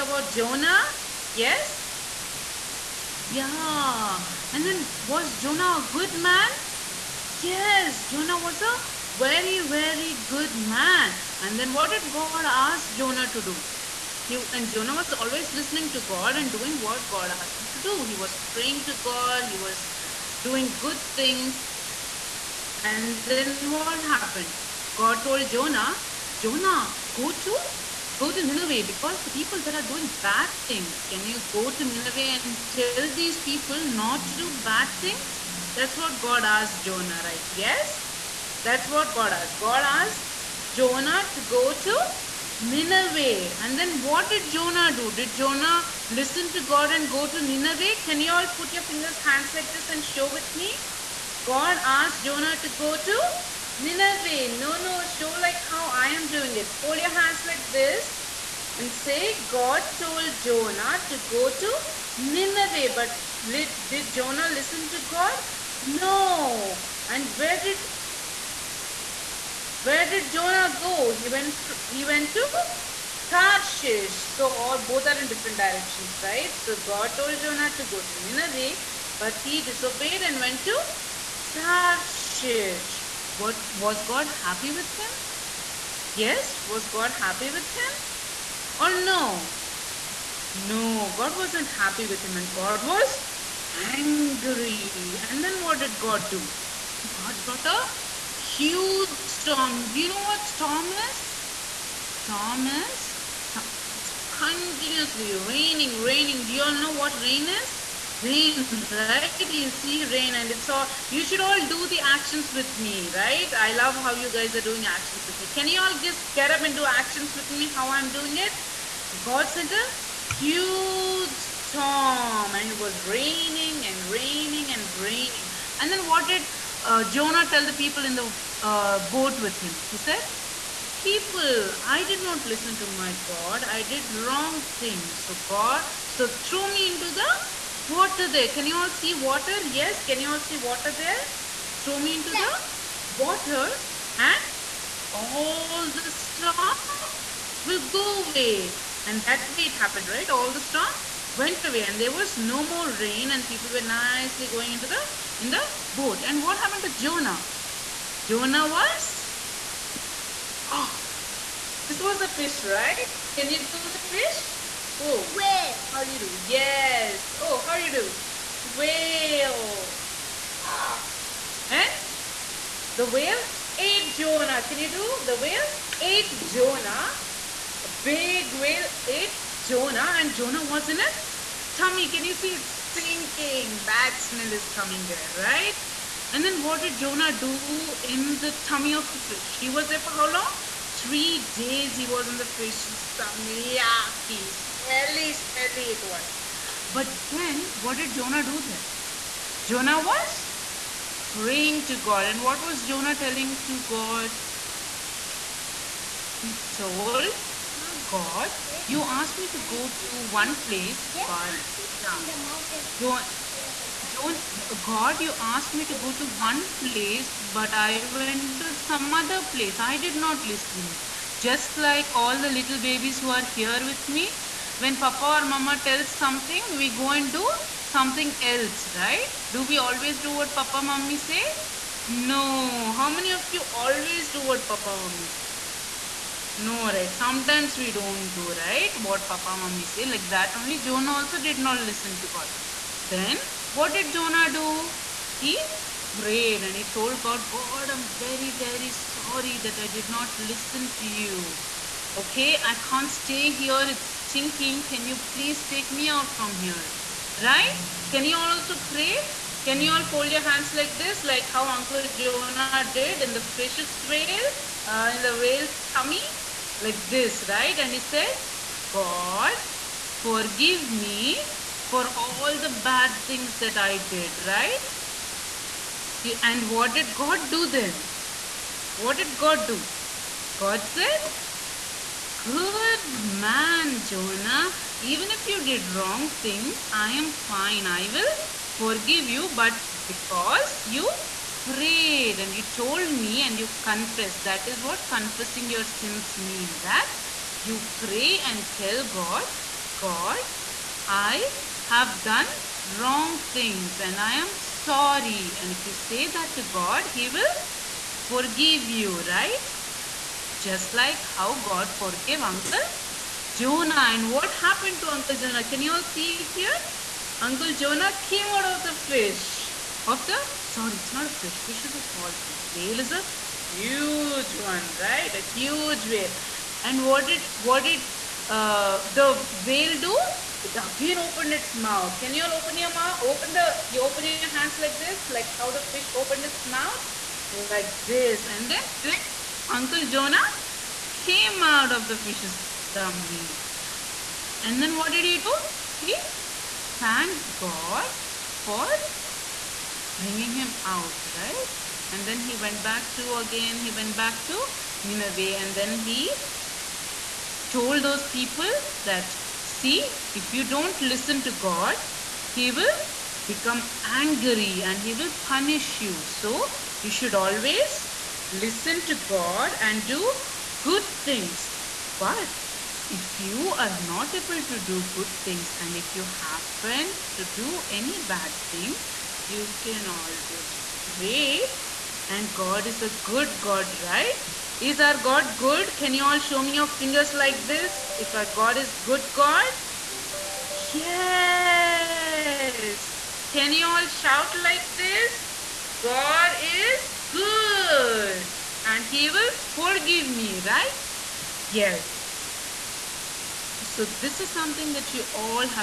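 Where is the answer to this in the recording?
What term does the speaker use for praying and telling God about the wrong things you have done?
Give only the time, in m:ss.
4:55.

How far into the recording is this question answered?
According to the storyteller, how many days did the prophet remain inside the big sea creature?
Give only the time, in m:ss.
3:10.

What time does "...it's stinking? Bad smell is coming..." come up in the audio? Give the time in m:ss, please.
3:02.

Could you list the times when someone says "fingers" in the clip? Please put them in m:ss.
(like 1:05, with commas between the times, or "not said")
0:48, 6:26.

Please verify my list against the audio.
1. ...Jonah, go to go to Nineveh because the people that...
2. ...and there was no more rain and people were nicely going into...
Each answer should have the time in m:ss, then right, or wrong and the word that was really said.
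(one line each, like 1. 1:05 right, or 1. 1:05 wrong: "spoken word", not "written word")
1. 0:26 right
2. 2:31 right.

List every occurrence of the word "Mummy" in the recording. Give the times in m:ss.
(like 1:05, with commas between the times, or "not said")
3:59.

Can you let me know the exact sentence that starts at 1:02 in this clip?
But did Jonah listen to God?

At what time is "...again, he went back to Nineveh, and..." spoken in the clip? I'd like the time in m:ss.
5:53.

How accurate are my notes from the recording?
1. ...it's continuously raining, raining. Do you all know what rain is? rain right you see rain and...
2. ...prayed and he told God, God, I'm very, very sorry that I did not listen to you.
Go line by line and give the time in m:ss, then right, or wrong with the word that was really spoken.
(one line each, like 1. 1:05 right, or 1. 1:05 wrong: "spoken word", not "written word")
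1. 1:43 right
2. 4:06 right.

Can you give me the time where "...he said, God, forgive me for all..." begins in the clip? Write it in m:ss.
4:27.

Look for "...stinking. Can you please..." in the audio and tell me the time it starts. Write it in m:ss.
4:14.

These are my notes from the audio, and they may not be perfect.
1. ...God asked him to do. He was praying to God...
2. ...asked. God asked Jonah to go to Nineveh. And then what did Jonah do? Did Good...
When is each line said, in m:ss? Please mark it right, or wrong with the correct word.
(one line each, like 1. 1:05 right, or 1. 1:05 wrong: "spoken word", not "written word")
1. 0:17 right
2. 0:39 wrong: "Jonah", not "Good".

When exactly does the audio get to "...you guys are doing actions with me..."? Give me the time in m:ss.
1:54.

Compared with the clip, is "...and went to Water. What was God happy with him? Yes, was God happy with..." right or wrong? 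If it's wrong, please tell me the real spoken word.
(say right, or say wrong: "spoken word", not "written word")
wrong: "Tarshish", not "Water".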